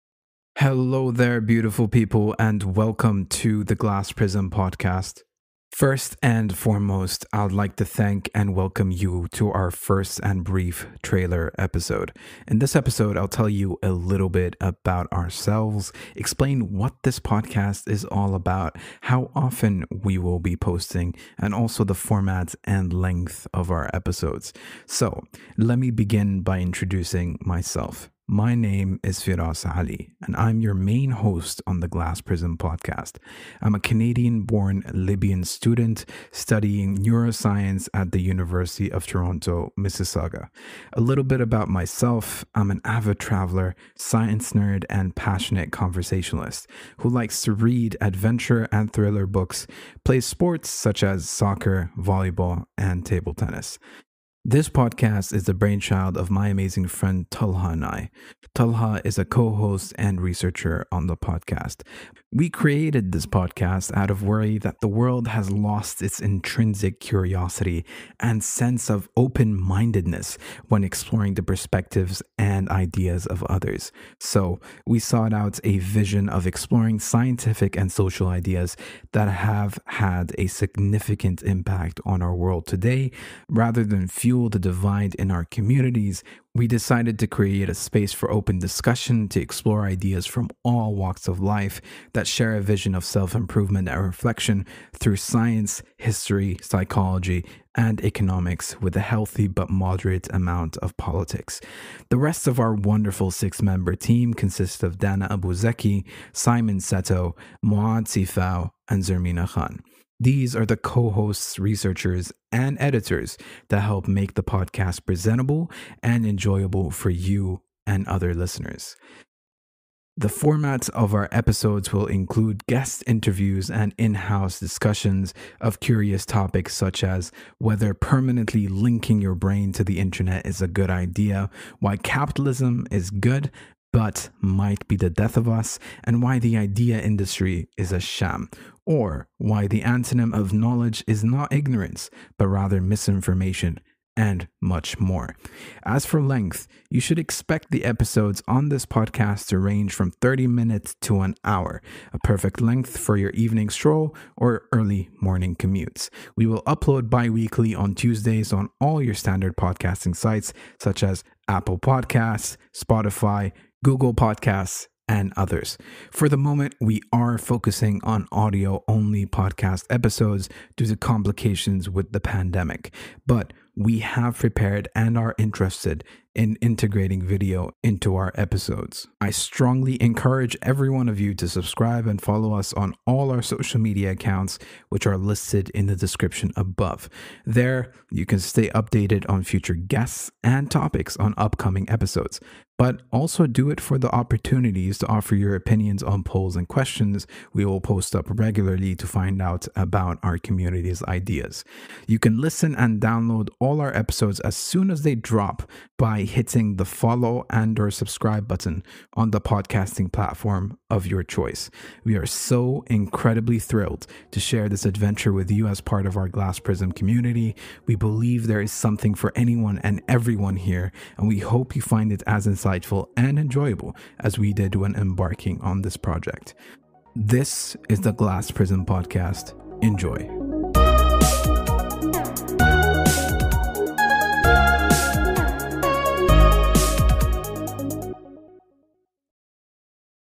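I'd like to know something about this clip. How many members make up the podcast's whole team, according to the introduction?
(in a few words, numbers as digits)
6.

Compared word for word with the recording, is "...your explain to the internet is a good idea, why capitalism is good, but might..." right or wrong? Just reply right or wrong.
wrong.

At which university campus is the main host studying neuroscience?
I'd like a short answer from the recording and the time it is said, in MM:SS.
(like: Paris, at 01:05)
University of Toronto, Mississauga, at 00:38.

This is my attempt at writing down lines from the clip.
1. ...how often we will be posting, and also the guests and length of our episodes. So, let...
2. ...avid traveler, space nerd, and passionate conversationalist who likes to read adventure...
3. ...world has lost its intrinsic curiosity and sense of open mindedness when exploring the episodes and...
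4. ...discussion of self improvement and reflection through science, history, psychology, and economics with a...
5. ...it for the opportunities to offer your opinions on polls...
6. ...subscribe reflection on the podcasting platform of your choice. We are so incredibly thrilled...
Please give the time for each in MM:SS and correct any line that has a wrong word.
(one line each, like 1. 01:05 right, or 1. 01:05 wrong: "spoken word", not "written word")
1. 00:19 wrong: "formats", not "guests"
2. 00:42 wrong: "science", not "space"
3. 01:04 wrong: "perspectives", not "episodes"
4. 01:32 wrong: "vision", not "discussion"
5. 03:13 right
6. 03:27 wrong: "button", not "reflection".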